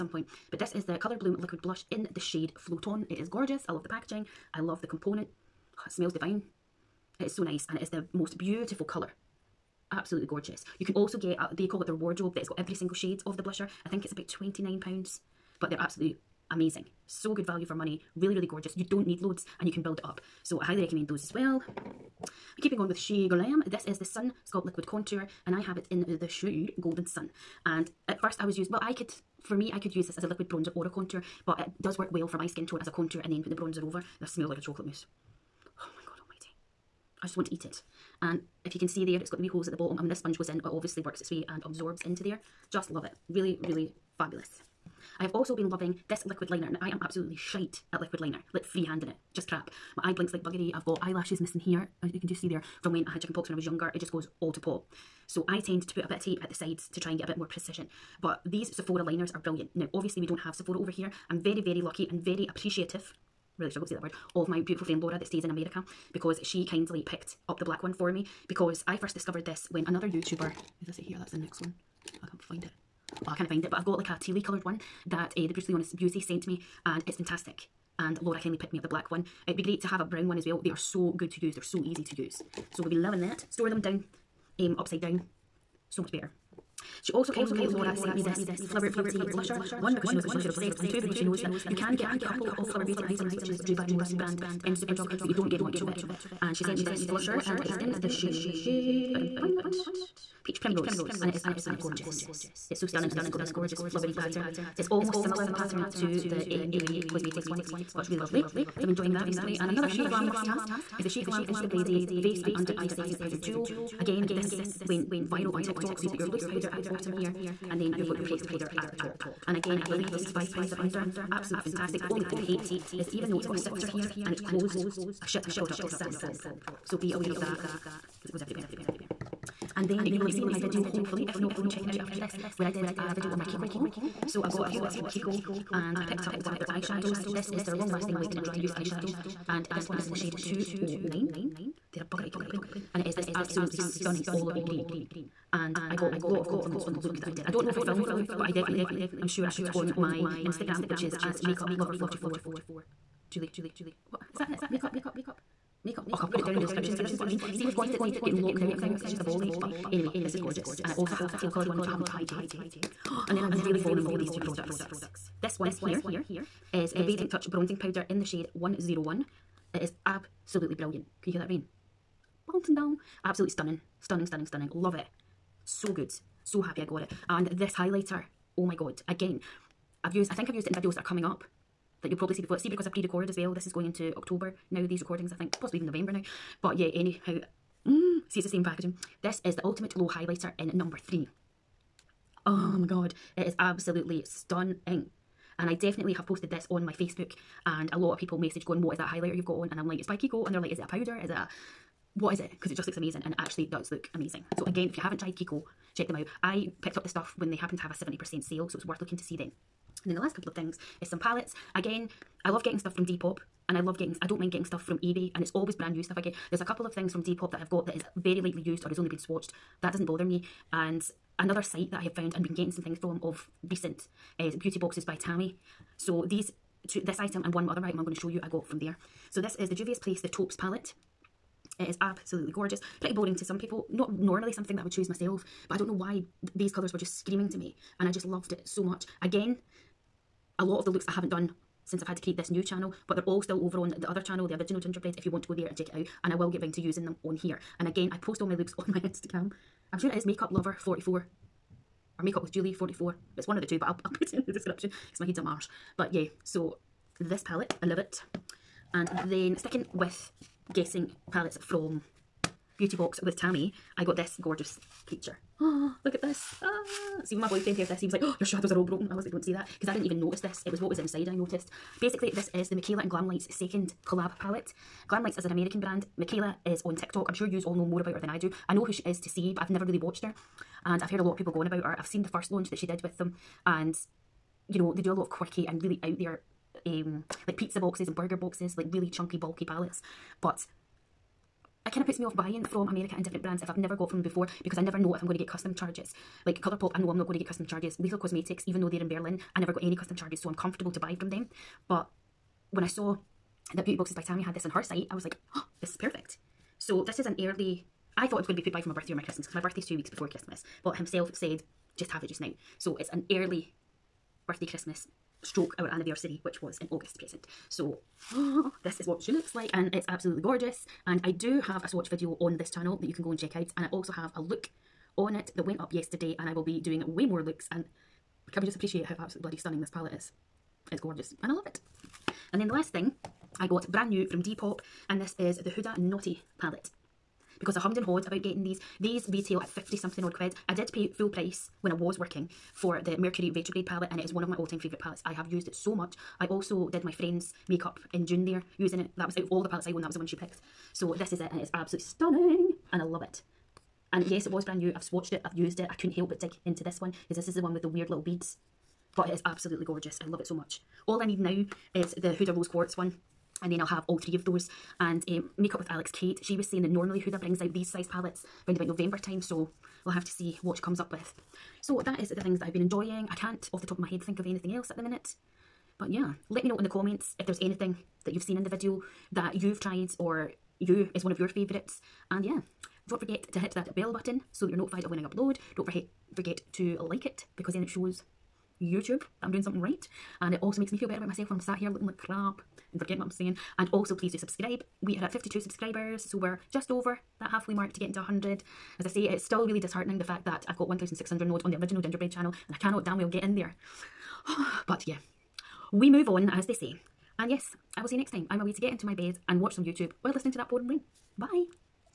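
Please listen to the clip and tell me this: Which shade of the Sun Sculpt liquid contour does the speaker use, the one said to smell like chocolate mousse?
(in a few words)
Golden Sun.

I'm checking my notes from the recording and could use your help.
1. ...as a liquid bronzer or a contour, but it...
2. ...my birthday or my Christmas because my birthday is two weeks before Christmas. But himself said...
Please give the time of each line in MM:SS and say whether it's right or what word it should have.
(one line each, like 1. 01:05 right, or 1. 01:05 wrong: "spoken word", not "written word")
1. 00:30 right
2. 05:08 right.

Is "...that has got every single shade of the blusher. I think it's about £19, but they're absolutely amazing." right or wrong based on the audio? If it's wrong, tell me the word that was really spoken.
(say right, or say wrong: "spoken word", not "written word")
wrong: "29", not "19".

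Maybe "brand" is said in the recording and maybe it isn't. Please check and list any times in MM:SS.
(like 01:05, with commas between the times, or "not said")
01:34, 03:35, 04:35, 04:53, 05:33, 05:54.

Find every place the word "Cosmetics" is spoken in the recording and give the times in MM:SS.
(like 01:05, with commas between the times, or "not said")
01:47, 04:58.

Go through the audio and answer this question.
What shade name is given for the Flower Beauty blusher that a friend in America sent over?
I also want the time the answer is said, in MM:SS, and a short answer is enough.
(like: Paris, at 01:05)
Peach Primrose, at 01:40.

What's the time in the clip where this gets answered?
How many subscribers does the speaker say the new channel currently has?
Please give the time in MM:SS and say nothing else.
06:35.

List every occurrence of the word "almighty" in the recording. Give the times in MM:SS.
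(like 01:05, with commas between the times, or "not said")
00:36.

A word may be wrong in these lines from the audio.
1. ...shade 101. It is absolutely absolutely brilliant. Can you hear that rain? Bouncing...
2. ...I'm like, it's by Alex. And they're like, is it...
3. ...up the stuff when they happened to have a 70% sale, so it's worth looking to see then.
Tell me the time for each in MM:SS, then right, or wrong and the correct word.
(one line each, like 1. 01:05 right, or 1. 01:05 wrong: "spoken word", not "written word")
1. 02:48 right
2. 03:19 wrong: "Kiko", not "Alex"
3. 03:26 right.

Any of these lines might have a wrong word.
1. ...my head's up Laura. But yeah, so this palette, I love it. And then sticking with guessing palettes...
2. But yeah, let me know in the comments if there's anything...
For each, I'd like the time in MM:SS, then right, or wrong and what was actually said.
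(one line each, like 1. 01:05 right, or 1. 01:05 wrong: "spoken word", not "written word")
1. 04:15 wrong: "Mars", not "Laura"
2. 06:15 right.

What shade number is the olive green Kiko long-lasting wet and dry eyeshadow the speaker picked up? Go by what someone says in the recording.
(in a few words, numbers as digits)
209.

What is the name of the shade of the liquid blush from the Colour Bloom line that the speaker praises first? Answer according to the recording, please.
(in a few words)
Float On.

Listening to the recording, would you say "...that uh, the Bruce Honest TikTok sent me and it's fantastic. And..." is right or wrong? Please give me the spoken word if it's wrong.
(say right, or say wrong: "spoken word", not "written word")
wrong: "Beauty", not "TikTok".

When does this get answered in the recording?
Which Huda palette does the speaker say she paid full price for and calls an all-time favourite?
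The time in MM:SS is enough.
05:43.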